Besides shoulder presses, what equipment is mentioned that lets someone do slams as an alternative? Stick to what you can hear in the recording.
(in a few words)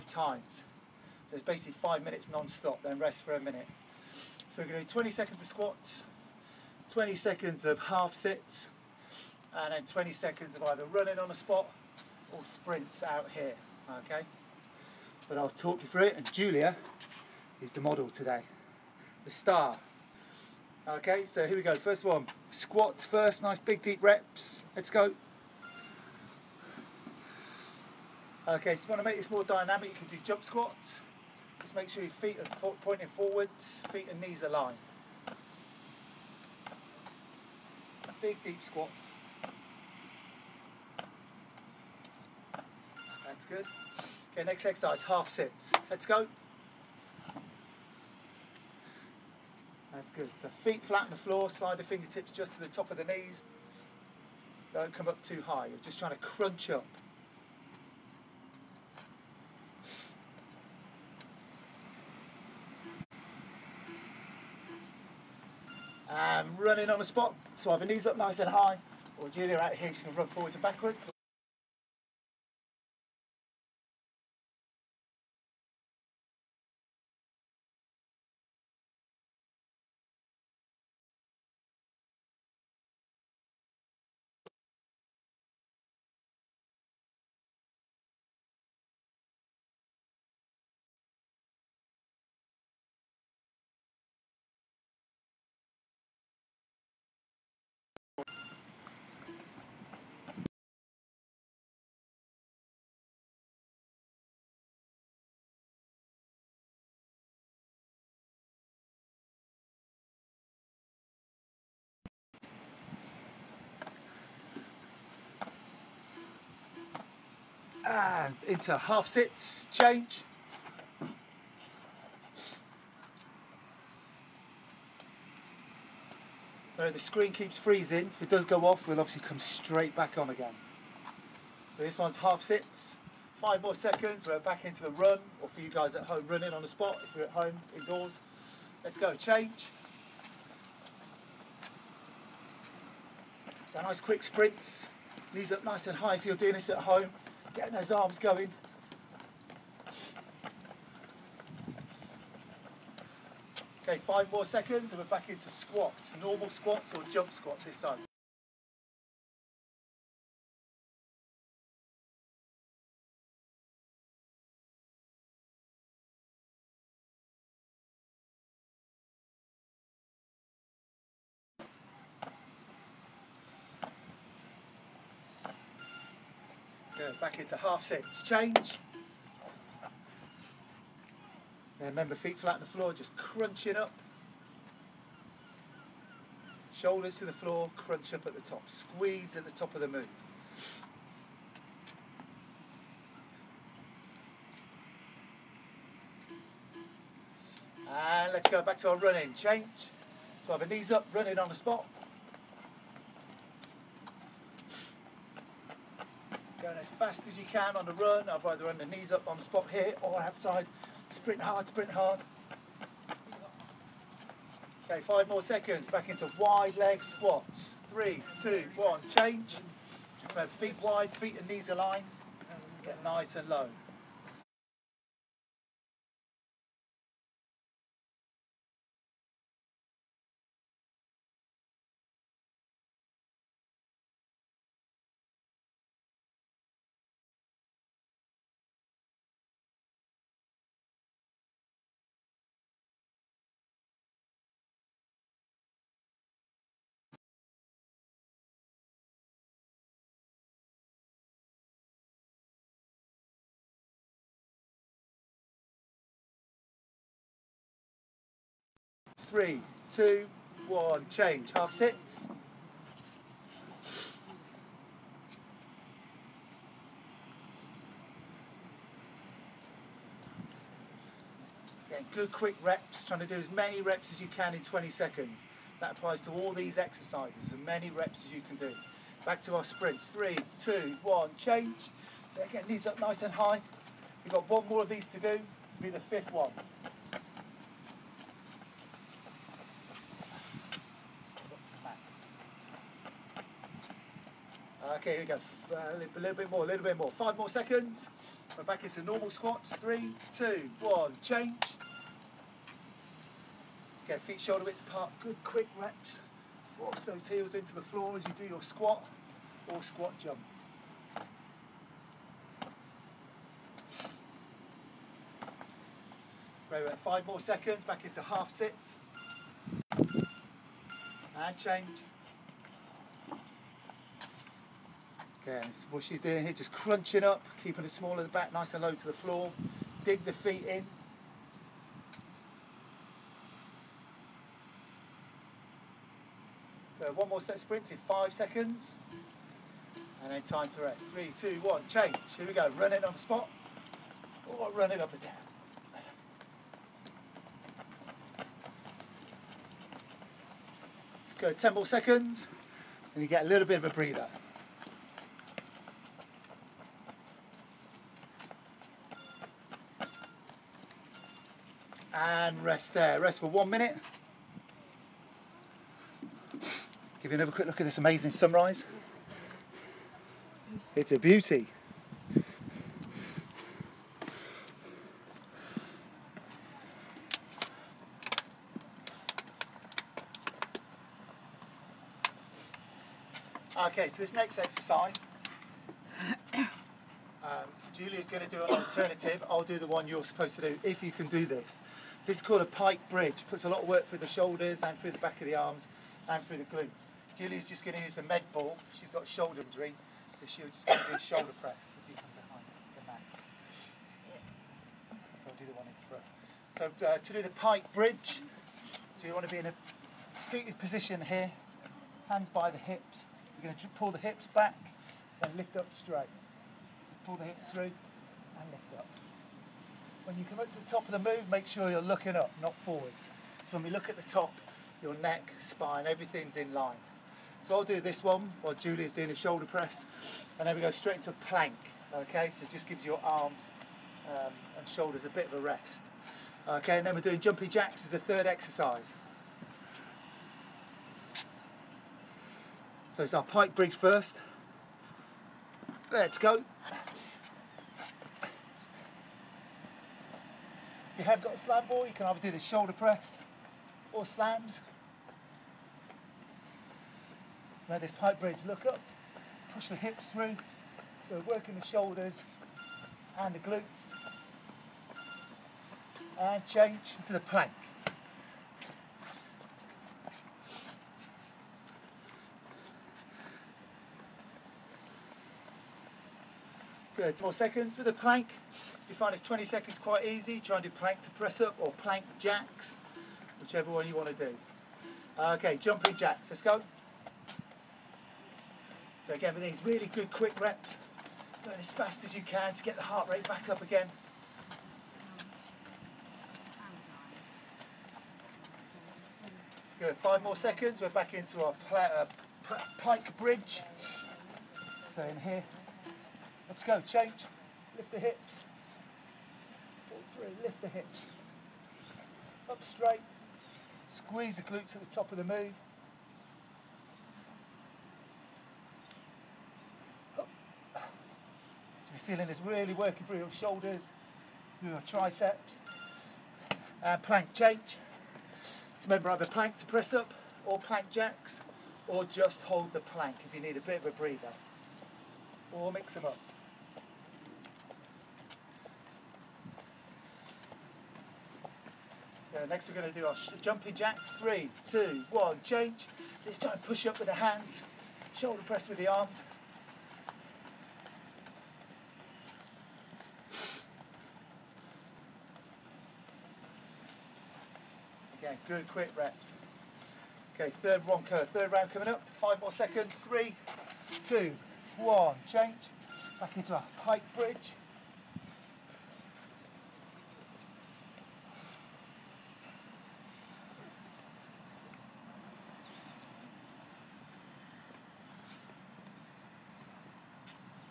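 slam ball.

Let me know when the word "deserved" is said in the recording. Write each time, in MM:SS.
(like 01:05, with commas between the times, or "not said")
not said.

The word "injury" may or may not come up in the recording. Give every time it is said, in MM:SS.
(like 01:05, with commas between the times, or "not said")
06:39.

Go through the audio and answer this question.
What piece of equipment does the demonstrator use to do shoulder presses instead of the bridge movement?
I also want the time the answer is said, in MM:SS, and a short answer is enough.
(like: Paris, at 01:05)
med ball, at 06:38.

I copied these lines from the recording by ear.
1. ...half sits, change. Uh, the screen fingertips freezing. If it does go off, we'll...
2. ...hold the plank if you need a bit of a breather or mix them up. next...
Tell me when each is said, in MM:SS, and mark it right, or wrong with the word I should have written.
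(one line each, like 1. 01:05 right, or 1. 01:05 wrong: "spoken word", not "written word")
1. 01:58 wrong: "keeps", not "fingertips"
2. 08:52 right.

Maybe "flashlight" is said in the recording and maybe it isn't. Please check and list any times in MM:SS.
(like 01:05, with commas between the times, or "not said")
not said.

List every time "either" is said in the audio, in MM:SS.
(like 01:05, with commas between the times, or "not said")
00:10, 01:07, 03:28, 07:32, 08:49.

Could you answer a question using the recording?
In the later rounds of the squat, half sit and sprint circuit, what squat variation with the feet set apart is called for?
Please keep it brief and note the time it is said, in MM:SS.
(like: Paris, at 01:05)
wide leg squats, at 03:36.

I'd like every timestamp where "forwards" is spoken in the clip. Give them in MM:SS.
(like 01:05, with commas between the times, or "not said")
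00:33, 01:10, 07:02.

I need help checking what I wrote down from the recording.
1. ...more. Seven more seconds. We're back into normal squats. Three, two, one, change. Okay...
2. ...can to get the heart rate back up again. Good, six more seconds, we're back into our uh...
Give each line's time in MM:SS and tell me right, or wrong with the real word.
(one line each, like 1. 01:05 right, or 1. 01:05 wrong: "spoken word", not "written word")
1. 04:56 wrong: "Five", not "Seven"
2. 08:12 wrong: "five", not "six".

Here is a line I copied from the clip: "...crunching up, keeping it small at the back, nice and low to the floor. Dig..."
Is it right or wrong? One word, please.
right.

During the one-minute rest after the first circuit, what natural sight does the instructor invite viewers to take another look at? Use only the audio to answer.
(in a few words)
sunrise.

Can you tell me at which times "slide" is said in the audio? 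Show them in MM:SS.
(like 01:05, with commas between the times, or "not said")
00:51.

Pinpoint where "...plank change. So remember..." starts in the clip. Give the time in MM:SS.
08:47.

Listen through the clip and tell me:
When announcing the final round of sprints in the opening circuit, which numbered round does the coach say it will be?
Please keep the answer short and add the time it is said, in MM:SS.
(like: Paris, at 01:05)
fifth, at 04:45.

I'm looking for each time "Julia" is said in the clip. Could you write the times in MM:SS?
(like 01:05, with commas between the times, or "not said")
00:16, 01:09, 06:27, 06:37, 07:08.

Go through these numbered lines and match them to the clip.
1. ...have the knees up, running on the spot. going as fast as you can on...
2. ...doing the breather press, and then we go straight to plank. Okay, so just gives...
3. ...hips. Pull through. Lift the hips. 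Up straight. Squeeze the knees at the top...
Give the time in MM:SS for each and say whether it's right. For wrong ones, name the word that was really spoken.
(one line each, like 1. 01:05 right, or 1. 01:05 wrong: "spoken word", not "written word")
1. 03:20 right
2. 07:09 wrong: "shoulder", not "breather"
3. 08:28 wrong: "glutes", not "knees".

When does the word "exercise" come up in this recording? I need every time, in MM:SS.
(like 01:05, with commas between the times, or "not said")
00:44, 04:36, 06:24, 07:18.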